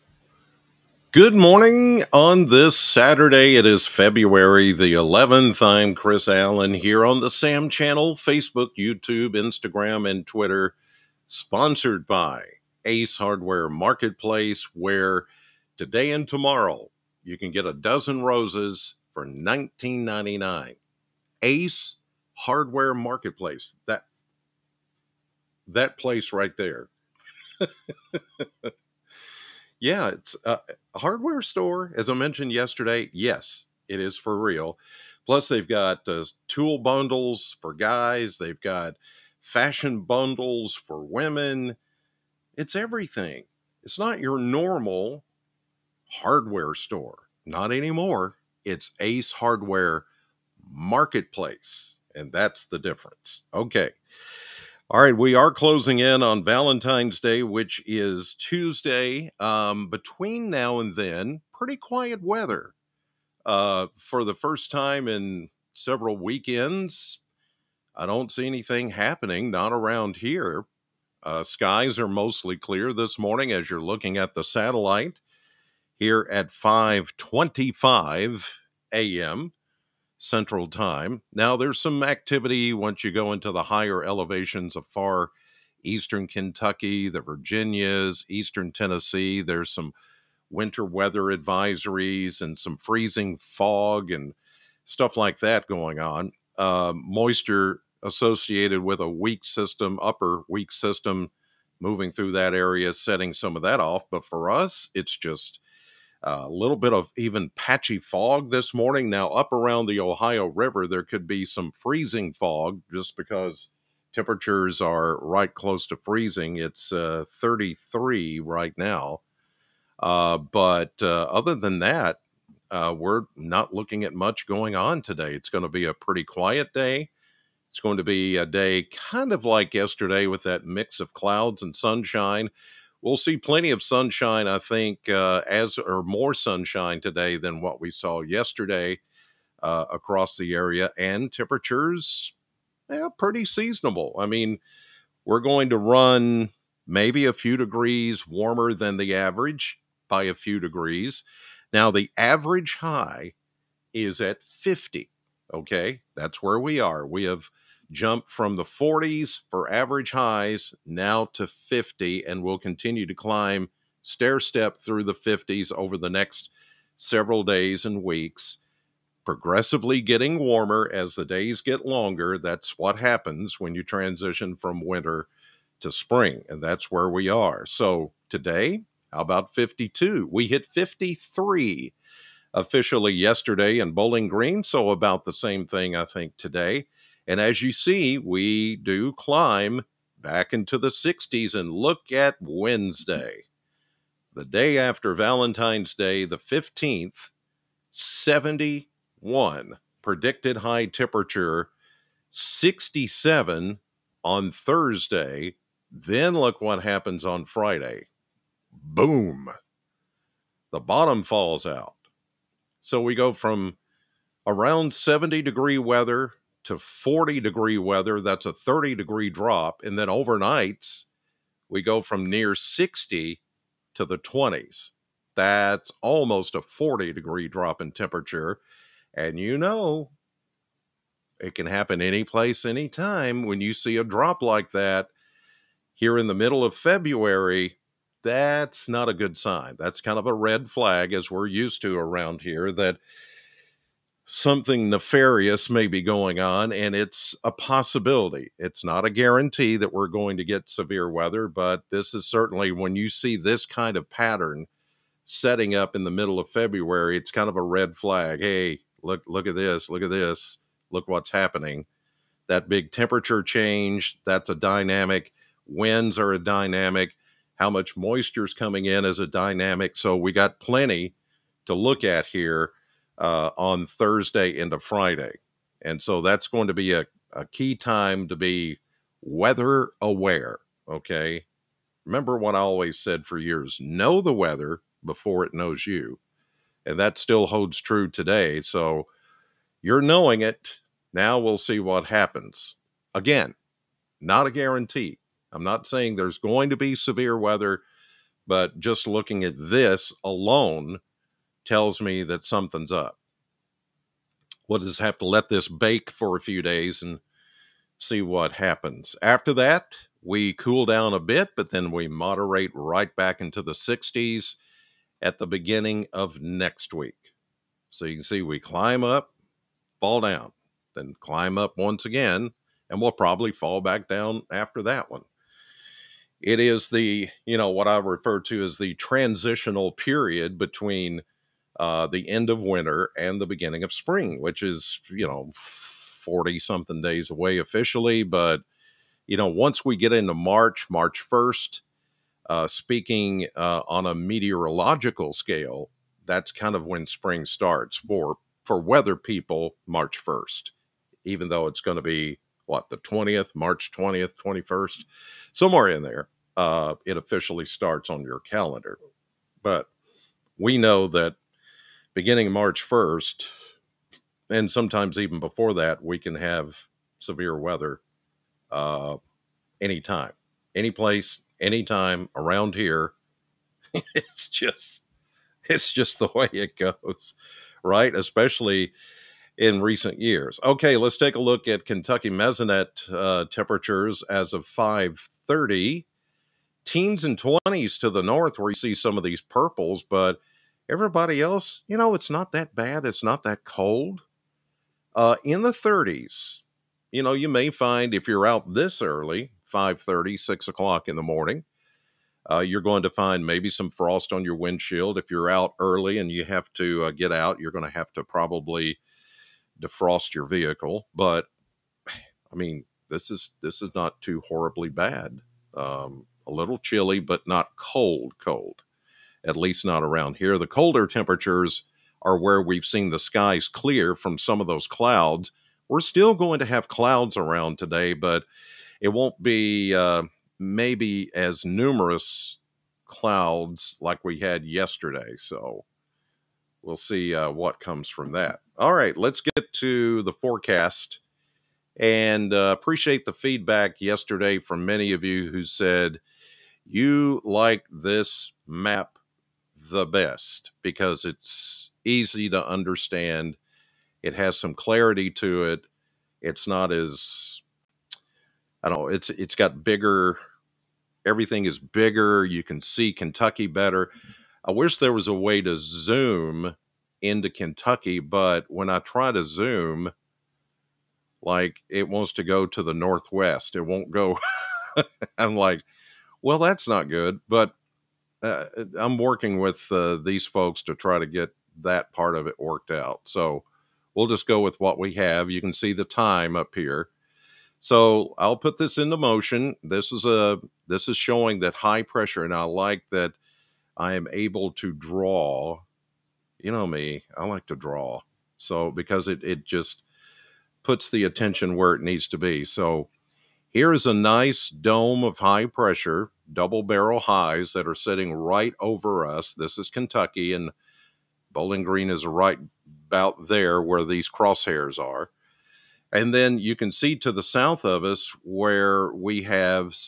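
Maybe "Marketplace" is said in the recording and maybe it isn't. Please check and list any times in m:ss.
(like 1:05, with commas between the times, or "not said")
0:13, 0:22, 0:50.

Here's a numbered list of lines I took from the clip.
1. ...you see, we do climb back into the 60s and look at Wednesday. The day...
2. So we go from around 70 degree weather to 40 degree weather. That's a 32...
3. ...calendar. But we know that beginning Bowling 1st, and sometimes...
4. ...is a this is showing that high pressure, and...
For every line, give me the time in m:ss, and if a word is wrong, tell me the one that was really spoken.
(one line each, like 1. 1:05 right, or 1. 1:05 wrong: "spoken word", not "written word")
1. 3:07 right
2. 3:32 wrong: "30", not "32"
3. 5:58 wrong: "March", not "Bowling"
4. 8:10 right.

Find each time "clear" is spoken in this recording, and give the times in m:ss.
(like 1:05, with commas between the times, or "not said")
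1:12, 7:03.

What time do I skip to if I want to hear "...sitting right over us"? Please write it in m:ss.
8:27.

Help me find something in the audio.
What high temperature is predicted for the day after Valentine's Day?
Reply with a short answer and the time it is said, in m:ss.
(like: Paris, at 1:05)
71, at 3:17.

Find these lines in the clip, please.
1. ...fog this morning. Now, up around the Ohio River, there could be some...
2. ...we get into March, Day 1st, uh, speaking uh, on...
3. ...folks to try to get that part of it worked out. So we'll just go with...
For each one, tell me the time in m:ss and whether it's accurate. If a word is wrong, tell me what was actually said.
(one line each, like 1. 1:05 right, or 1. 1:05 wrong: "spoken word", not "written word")
1. 1:47 right
2. 5:39 wrong: "March", not "Day"
3. 8:00 right.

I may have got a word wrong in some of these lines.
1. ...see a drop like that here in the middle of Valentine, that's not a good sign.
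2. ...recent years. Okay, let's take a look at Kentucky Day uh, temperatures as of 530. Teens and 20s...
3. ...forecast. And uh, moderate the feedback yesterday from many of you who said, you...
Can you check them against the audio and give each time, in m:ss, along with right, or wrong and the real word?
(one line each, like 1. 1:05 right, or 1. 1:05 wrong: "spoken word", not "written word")
1. 3:53 wrong: "February", not "Valentine"
2. 6:19 wrong: "Mesonet", not "Day"
3. 7:20 wrong: "appreciate", not "moderate".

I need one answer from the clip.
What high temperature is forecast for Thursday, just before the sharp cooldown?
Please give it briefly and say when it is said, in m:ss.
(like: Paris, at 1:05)
67, at 3:22.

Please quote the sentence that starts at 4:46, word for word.
And that still holds true today.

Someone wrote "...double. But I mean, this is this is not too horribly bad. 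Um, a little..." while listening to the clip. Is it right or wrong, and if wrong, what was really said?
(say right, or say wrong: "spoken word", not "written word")
wrong: "vehicle", not "double".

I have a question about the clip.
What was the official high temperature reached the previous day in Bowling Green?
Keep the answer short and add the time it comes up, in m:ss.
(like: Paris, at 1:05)
53, at 3:00.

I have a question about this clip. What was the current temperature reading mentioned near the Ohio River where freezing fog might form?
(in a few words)
33.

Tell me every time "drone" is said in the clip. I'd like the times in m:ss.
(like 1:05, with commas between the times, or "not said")
not said.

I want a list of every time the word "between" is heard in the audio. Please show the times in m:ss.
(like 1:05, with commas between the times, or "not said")
0:59, 5:30.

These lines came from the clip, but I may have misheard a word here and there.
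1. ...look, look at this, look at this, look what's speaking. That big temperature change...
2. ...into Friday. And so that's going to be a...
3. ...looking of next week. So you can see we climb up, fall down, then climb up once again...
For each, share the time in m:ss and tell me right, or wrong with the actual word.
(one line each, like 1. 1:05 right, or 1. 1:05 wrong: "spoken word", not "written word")
1. 4:19 wrong: "happening", not "speaking"
2. 4:34 right
3. 5:15 wrong: "beginning", not "looking".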